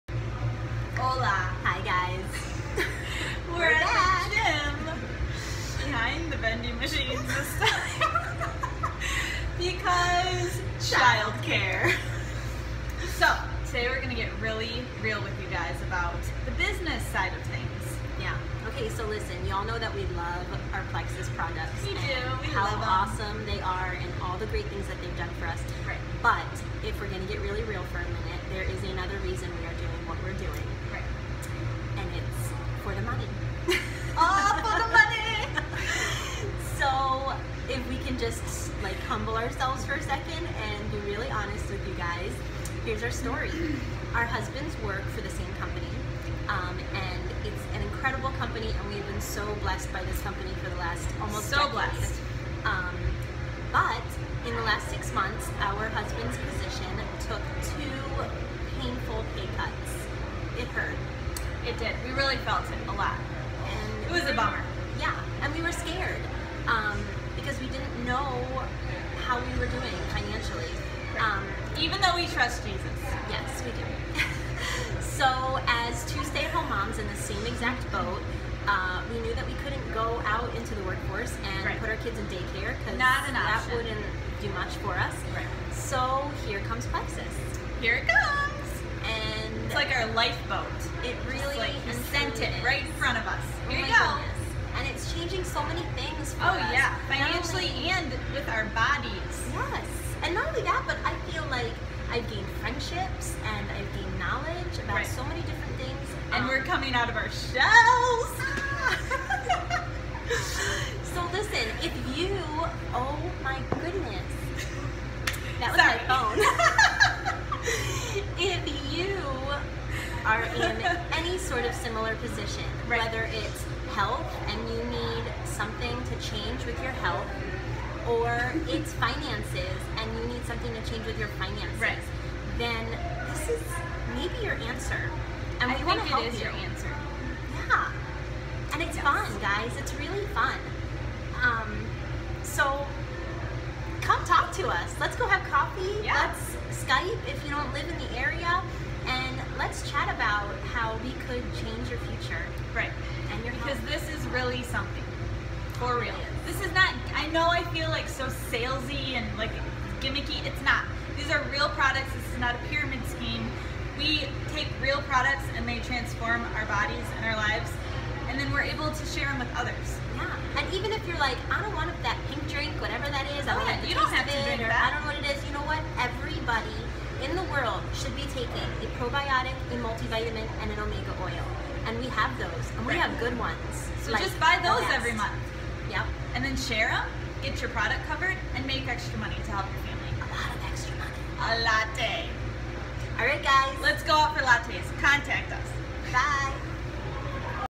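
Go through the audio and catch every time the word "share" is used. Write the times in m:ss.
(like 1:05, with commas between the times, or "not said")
2:49, 3:06.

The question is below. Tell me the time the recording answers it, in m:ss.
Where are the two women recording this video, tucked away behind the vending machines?
0:04.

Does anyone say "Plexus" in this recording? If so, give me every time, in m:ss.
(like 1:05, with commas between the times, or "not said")
0:20, 1:26.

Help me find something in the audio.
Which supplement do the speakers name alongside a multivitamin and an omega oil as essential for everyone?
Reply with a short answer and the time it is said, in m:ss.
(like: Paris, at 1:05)
probiotic, at 2:58.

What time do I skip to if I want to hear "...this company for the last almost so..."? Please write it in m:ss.
0:50.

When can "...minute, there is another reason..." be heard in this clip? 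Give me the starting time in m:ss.
0:28.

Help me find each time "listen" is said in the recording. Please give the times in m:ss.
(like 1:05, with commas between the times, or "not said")
0:19, 1:51.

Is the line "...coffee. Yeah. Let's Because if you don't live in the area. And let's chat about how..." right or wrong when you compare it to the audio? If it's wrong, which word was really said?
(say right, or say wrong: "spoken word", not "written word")
wrong: "Skype", not "Because".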